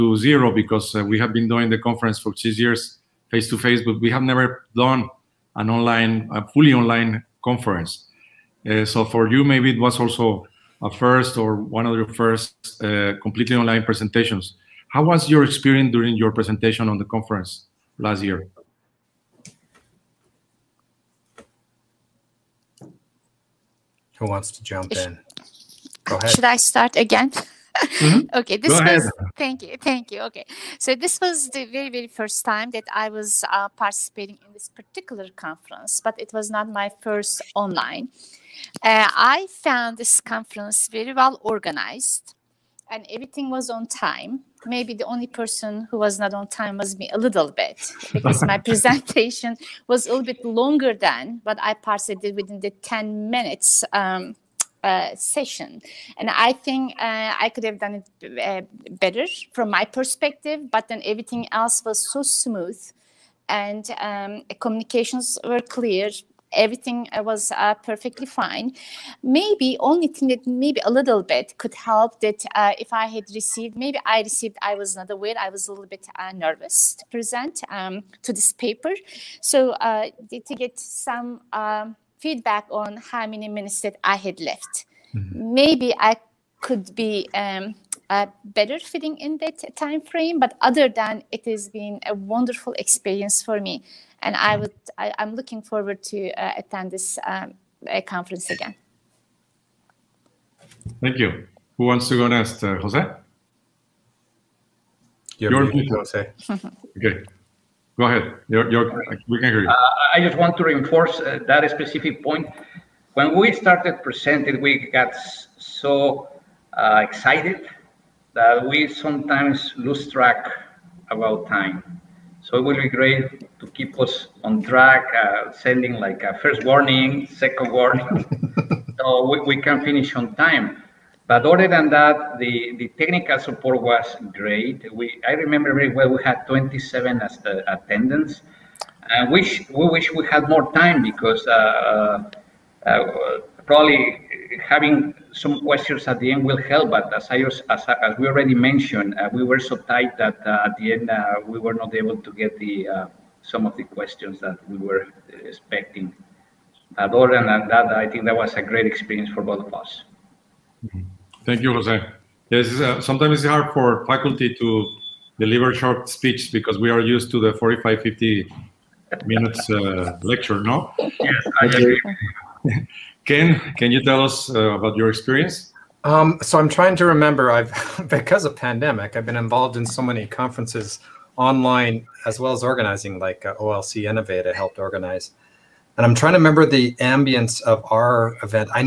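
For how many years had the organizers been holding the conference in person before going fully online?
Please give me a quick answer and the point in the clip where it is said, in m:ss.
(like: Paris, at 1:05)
6, at 0:02.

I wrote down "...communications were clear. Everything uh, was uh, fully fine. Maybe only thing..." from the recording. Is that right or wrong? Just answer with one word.
wrong.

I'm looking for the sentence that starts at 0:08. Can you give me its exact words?
Uh, so for you, maybe it was also a first or one of your first uh, completely online presentations.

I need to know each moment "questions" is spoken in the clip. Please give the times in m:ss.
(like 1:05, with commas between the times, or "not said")
2:25, 2:33.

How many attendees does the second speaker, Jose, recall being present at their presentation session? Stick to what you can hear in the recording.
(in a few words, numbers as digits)
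27.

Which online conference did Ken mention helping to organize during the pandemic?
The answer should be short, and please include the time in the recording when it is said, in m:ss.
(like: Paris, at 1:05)
OLC Innovate, at 3:03.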